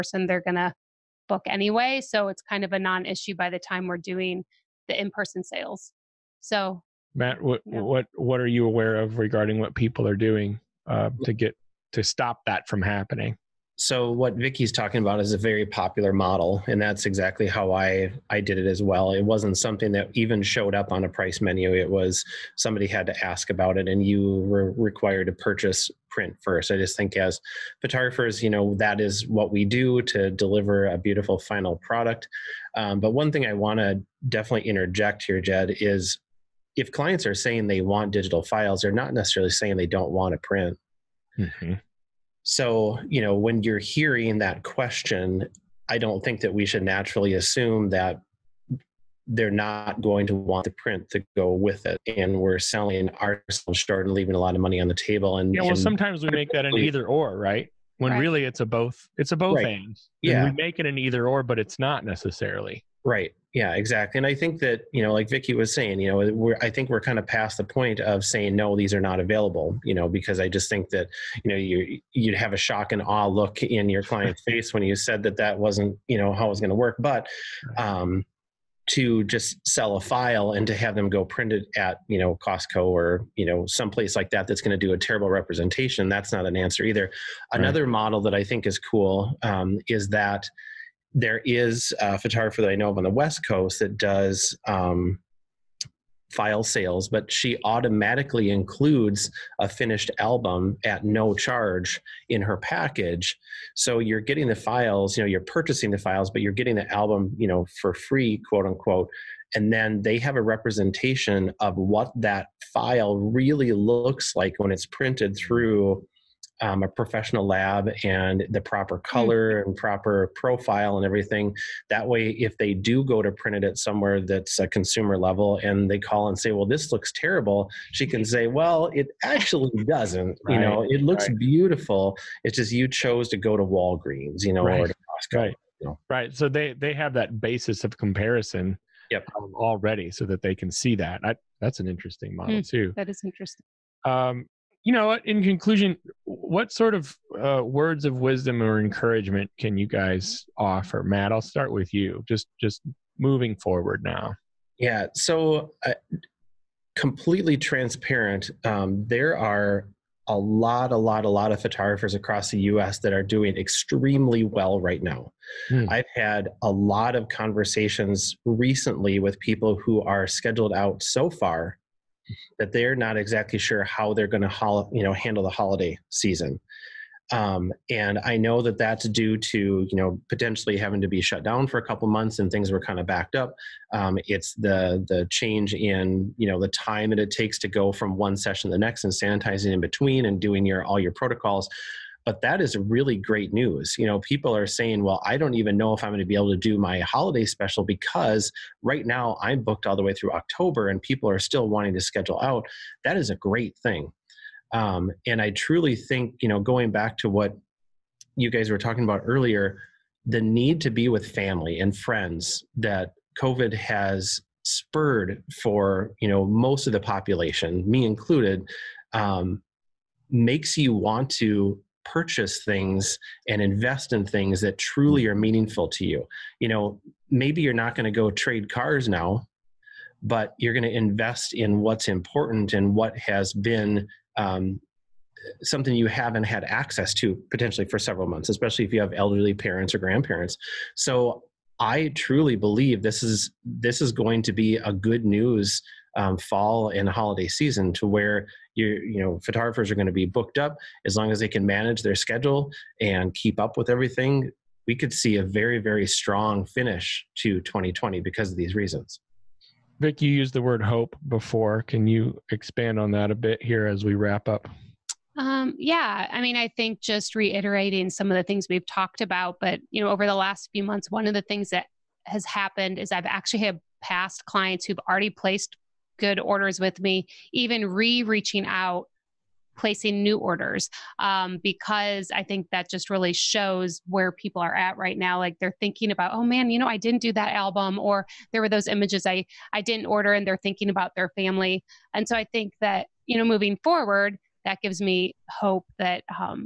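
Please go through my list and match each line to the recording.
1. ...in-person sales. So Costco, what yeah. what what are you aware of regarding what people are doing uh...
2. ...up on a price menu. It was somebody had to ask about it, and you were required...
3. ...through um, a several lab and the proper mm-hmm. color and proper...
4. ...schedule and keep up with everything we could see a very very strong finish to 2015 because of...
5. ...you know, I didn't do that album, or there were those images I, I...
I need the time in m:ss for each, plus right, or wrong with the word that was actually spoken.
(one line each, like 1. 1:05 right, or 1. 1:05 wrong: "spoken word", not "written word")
1. 0:05 wrong: "Matt", not "Costco"
2. 0:20 right
3. 1:55 wrong: "professional", not "several"
4. 4:12 wrong: "2020", not "2015"
5. 4:46 right.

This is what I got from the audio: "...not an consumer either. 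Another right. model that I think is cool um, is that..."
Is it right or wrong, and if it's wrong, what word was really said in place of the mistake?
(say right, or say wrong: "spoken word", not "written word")
wrong: "answer", not "consumer".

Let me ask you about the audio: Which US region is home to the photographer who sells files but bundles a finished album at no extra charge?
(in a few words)
West Coast.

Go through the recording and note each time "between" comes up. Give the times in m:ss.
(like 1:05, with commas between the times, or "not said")
3:09.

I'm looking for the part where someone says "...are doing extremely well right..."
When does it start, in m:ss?
2:43.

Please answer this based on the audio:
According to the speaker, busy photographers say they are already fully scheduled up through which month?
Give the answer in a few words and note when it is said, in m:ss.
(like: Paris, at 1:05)
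October, at 3:20.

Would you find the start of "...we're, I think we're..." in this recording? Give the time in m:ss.
1:06.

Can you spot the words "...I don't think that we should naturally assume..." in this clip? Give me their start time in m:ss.
0:45.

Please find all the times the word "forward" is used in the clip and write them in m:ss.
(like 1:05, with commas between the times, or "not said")
2:33, 4:53.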